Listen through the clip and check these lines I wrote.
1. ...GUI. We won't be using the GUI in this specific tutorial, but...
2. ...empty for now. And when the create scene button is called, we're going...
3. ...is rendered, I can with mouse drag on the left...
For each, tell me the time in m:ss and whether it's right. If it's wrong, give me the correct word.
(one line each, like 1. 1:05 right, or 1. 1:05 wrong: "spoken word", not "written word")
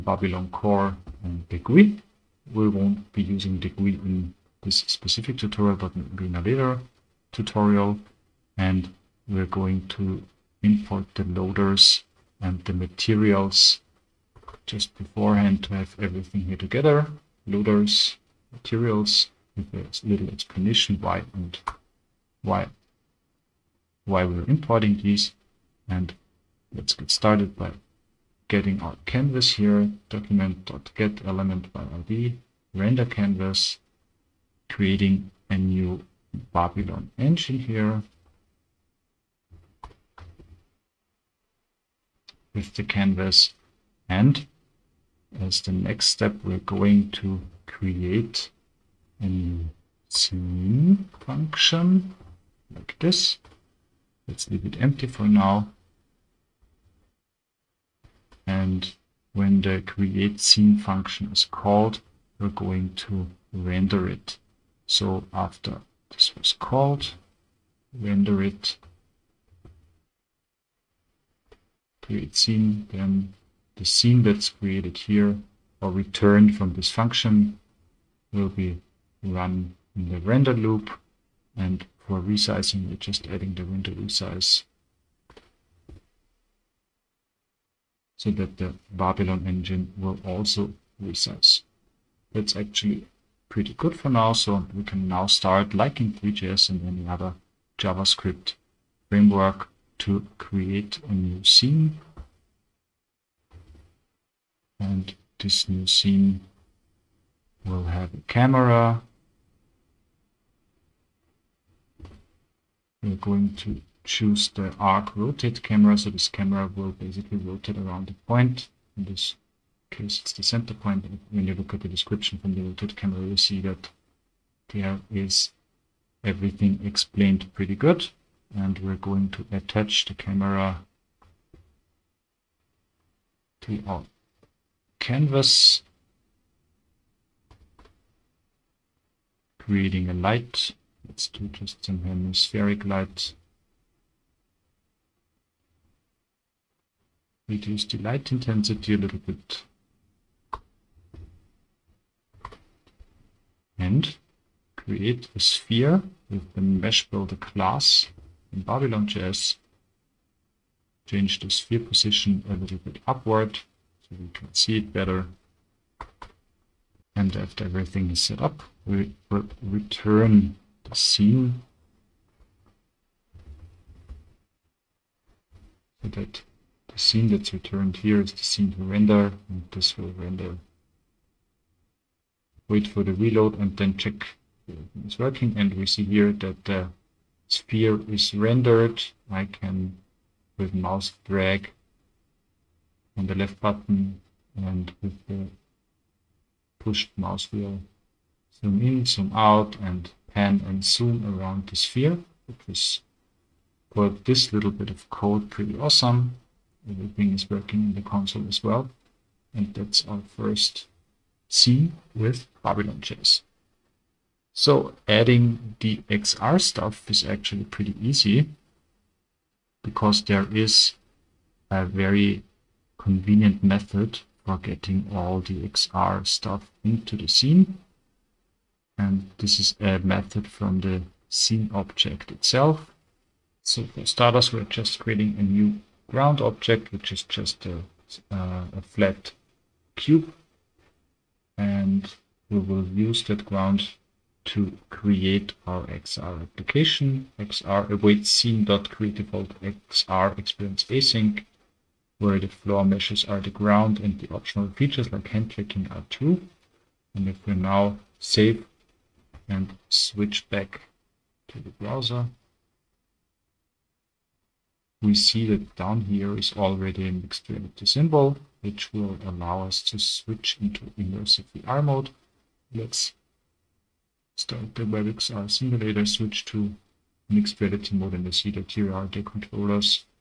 1. 0:01 right
2. 0:54 wrong: "function", not "button"
3. 3:08 right.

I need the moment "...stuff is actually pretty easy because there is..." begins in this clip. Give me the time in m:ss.
3:36.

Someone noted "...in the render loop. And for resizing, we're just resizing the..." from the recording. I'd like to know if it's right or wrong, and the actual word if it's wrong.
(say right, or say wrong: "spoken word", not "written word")
wrong: "adding", not "resizing".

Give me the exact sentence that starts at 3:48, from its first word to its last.
And this is a method from the scene object itself.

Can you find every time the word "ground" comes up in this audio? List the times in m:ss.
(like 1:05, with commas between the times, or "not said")
3:56, 4:03, 4:13.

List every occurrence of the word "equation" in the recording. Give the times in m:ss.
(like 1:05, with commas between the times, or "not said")
not said.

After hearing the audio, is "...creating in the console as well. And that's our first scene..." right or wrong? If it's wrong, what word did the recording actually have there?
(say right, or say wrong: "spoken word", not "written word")
wrong: "working", not "creating".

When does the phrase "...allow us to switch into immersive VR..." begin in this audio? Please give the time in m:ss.
4:29.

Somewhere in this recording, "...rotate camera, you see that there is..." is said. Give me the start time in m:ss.
2:02.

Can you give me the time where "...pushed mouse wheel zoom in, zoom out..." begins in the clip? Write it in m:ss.
3:16.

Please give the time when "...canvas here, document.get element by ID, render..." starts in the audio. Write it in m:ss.
0:29.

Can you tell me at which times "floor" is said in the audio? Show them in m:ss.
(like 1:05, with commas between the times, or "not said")
4:12.